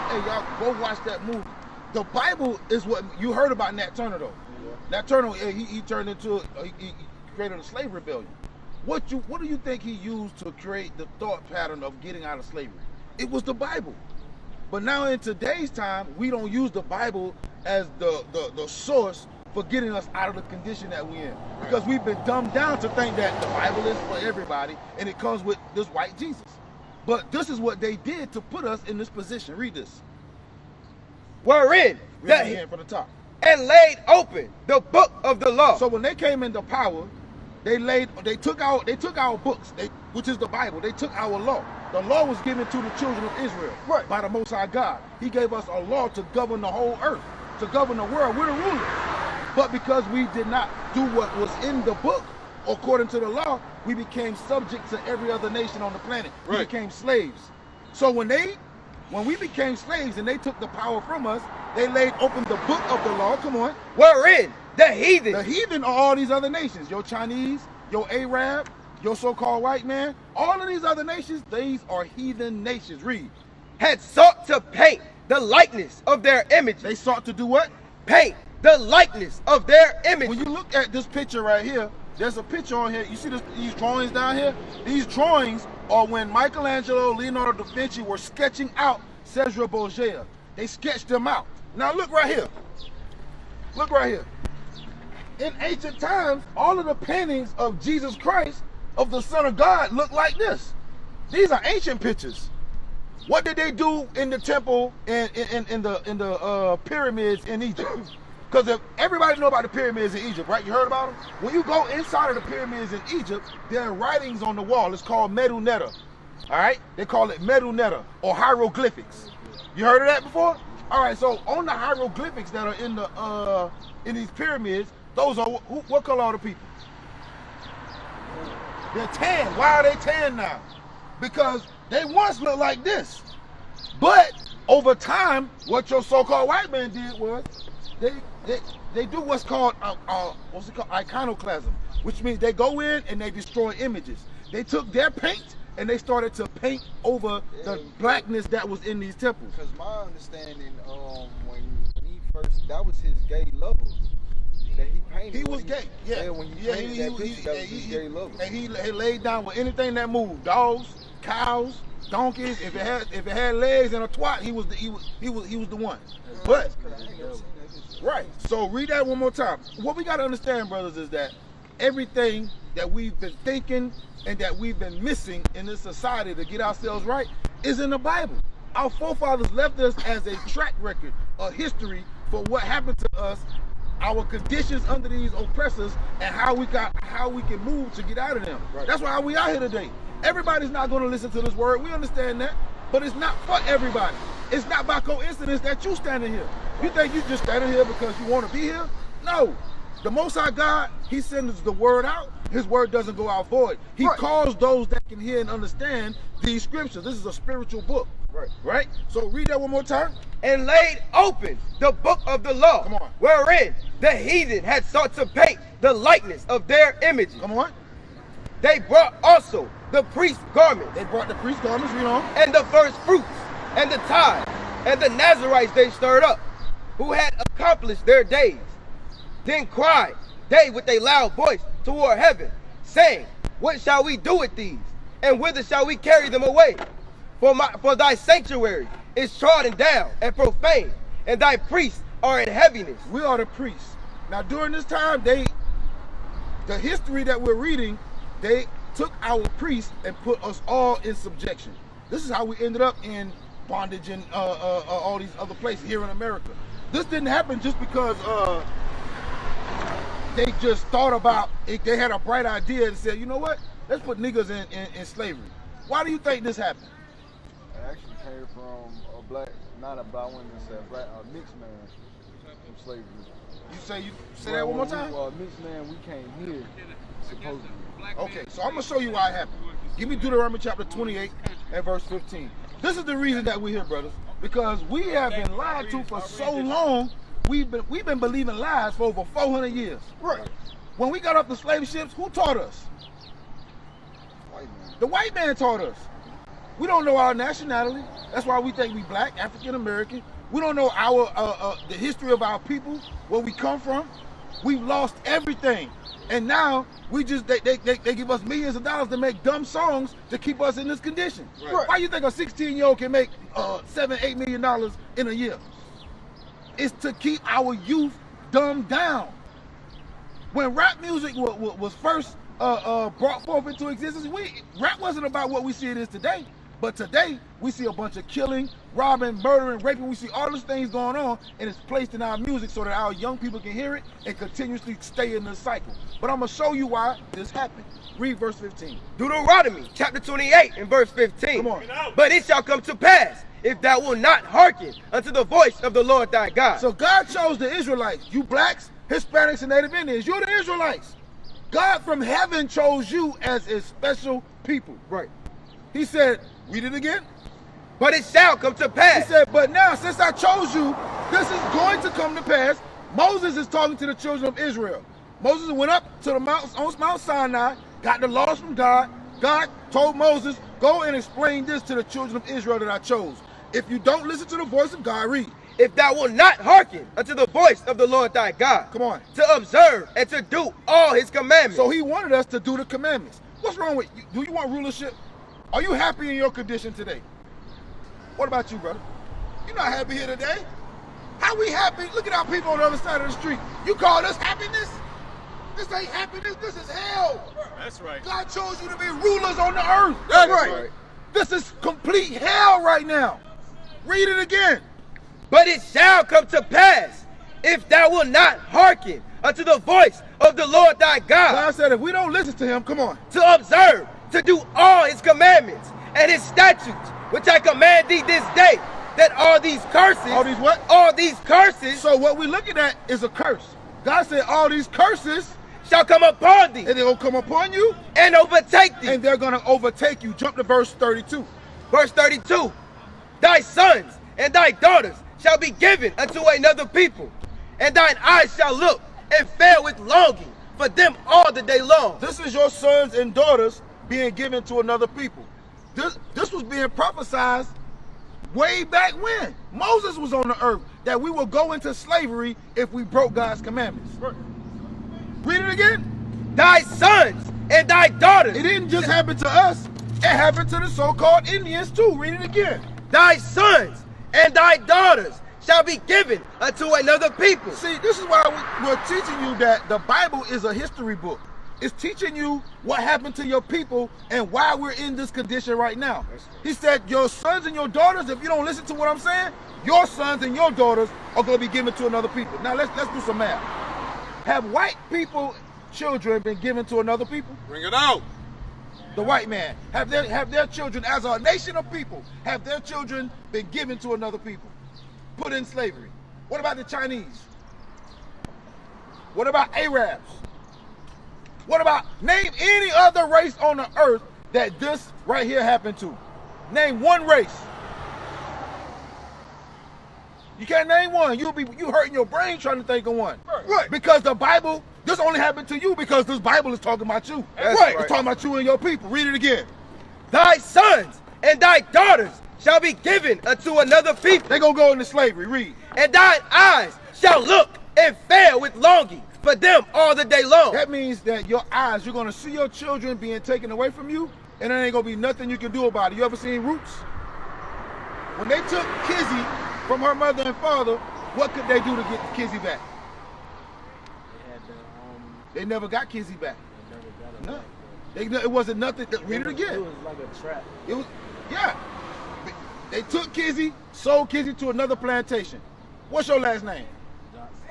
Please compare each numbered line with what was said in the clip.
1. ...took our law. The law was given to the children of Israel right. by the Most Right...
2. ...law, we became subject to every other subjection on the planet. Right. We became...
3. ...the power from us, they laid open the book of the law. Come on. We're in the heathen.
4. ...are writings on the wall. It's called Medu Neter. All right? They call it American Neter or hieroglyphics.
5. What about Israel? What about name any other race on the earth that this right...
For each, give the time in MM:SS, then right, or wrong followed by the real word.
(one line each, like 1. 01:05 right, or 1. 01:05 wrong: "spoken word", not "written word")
1. 00:40 wrong: "High", not "Right"
2. 00:53 wrong: "nation", not "subjection"
3. 01:00 right
4. 01:53 wrong: "Medu", not "American"
5. 08:19 wrong: "Arabs", not "Israel".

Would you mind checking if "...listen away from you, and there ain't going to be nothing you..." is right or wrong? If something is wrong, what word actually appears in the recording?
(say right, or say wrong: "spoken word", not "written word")
wrong: "taken", not "listen".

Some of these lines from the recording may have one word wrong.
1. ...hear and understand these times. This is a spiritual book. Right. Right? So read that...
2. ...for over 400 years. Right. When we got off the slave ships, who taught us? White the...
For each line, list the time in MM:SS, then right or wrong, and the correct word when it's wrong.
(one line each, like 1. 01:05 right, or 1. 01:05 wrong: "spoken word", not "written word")
1. 03:25 wrong: "scriptures", not "times"
2. 04:48 right.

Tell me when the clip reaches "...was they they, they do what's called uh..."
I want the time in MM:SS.
02:17.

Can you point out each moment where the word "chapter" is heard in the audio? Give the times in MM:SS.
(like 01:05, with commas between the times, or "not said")
04:40, 05:39.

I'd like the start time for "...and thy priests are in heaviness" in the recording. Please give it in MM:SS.
04:01.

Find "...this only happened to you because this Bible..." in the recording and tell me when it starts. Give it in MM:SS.
08:35.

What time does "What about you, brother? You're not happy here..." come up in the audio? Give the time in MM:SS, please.
06:28.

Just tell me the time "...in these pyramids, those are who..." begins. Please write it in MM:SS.
02:04.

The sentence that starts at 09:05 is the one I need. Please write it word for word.
They um, never got Kizzy back.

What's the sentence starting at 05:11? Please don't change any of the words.
Why you think a 16 year old can make uh, seven, eight million dollars in a year?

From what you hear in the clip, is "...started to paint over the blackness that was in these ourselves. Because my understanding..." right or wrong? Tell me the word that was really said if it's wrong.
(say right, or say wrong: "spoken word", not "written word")
wrong: "temples", not "ourselves".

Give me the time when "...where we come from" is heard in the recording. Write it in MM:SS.
05:03.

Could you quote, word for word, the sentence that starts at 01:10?
All of these other nations, these are heathen nations.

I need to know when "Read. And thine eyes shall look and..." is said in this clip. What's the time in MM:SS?
08:45.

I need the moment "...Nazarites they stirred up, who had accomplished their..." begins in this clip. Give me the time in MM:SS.
03:45.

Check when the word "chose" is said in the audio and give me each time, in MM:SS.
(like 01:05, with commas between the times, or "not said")
05:47, 05:52, 06:00, 06:12, 06:38.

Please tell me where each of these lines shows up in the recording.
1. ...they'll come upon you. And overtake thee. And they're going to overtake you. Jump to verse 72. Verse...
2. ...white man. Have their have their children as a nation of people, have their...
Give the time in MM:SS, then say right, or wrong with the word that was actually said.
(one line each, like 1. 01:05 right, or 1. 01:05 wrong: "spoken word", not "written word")
1. 07:06 wrong: "32", not "72"
2. 08:09 right.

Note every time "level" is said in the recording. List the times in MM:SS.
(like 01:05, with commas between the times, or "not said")
02:38.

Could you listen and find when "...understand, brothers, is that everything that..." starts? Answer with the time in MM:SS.
02:50.